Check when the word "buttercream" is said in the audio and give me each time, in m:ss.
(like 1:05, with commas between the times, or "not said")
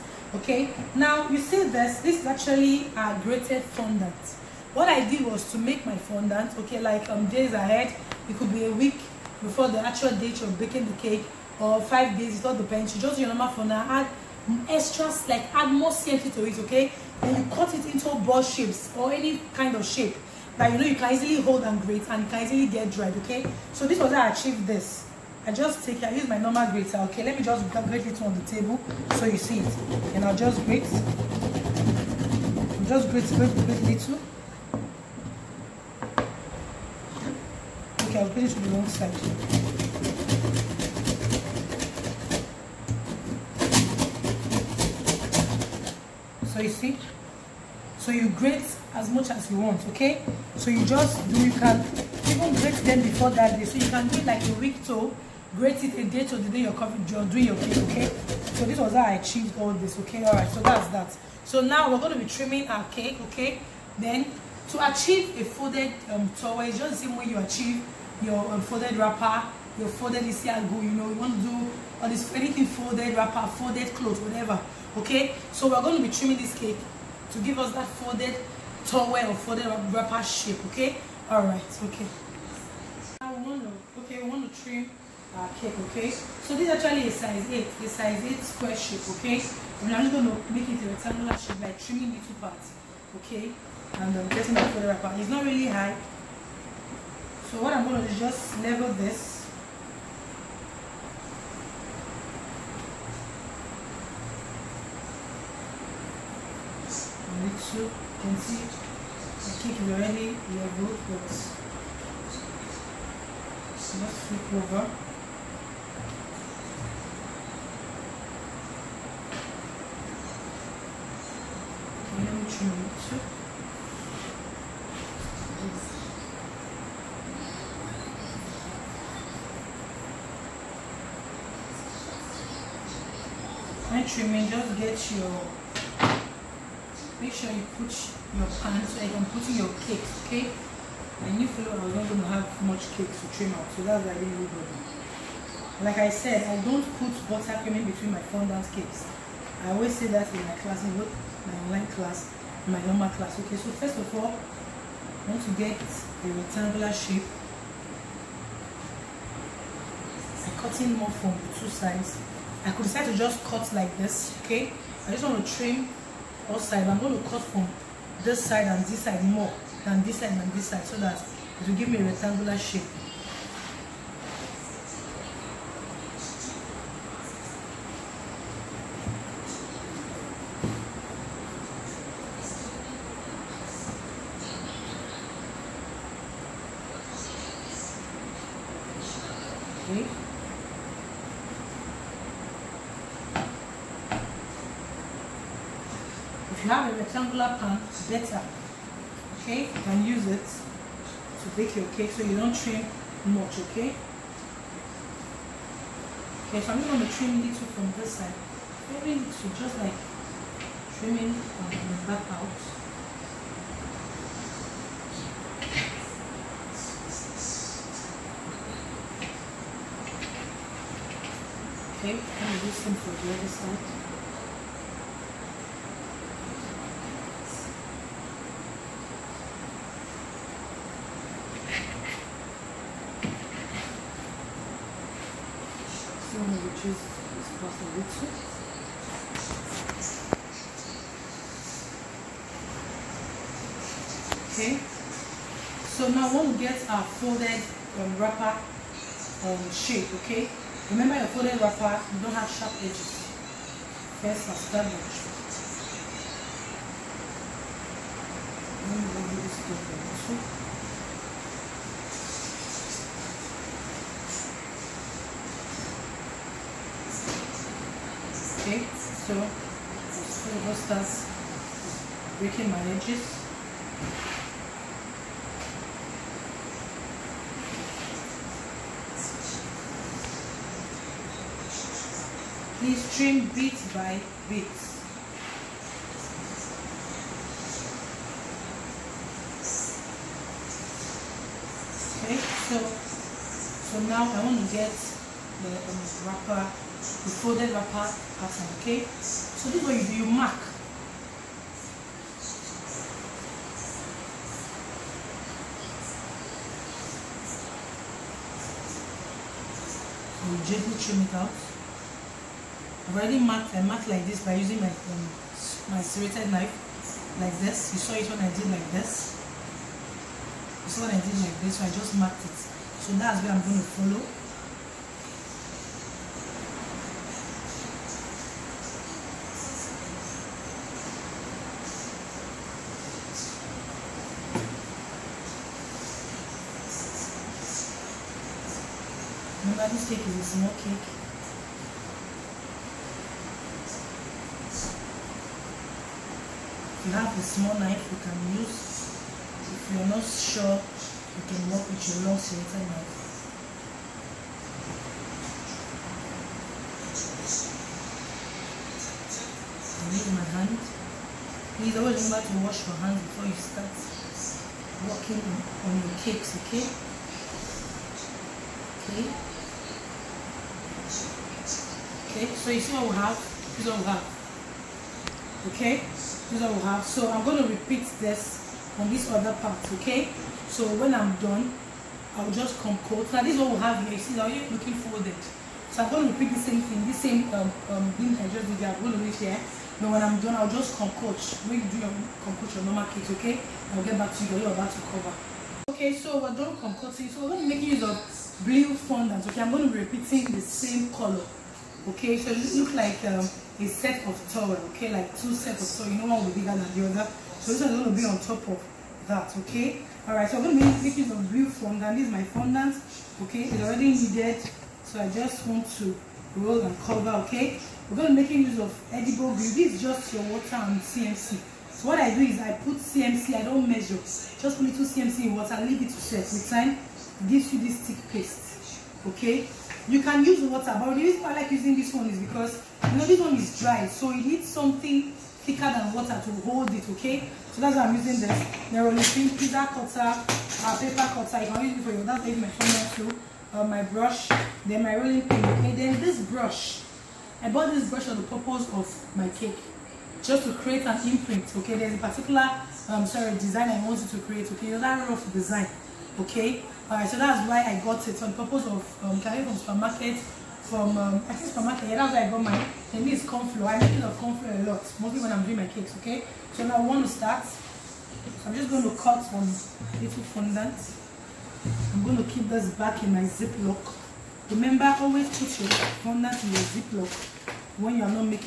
2:27.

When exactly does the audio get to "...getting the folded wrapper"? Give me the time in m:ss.
1:34.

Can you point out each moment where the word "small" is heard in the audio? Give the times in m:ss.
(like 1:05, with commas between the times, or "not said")
5:40, 5:47.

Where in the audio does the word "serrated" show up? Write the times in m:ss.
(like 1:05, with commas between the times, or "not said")
5:16, 5:52.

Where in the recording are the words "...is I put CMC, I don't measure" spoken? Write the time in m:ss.
7:02.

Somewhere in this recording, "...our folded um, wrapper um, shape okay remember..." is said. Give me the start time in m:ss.
4:06.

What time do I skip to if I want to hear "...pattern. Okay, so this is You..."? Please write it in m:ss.
4:58.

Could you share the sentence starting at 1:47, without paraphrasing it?
And so you can see I think we already we are but so let's flip over.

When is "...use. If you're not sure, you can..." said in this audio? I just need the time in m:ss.
5:48.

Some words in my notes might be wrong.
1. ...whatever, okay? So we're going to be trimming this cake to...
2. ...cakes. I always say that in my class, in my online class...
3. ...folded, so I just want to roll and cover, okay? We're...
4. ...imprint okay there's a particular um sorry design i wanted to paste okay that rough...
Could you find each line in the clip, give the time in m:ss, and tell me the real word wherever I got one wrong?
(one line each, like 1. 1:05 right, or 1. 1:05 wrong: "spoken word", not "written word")
1. 1:14 right
2. 2:28 right
3. 6:54 wrong: "needed", not "folded"
4. 7:31 wrong: "create", not "paste".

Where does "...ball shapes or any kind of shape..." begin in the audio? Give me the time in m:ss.
0:18.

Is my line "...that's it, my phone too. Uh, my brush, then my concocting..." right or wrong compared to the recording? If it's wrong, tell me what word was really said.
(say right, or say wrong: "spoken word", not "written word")
wrong: "rolling", not "concocting".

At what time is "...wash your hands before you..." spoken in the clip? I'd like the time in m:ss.
6:02.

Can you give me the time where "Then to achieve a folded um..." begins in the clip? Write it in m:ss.
1:03.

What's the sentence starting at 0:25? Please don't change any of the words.
I just take it, I use my normal grater, okay?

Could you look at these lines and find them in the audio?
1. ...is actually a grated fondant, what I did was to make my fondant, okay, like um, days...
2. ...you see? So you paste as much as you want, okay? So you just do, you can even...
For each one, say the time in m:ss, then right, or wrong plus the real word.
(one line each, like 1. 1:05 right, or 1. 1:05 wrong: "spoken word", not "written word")
1. 0:02 right
2. 0:46 wrong: "grate", not "paste".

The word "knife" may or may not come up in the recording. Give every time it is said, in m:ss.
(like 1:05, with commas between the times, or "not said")
5:16, 5:47, 5:52.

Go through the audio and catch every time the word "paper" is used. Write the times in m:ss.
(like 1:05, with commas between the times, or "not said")
7:20.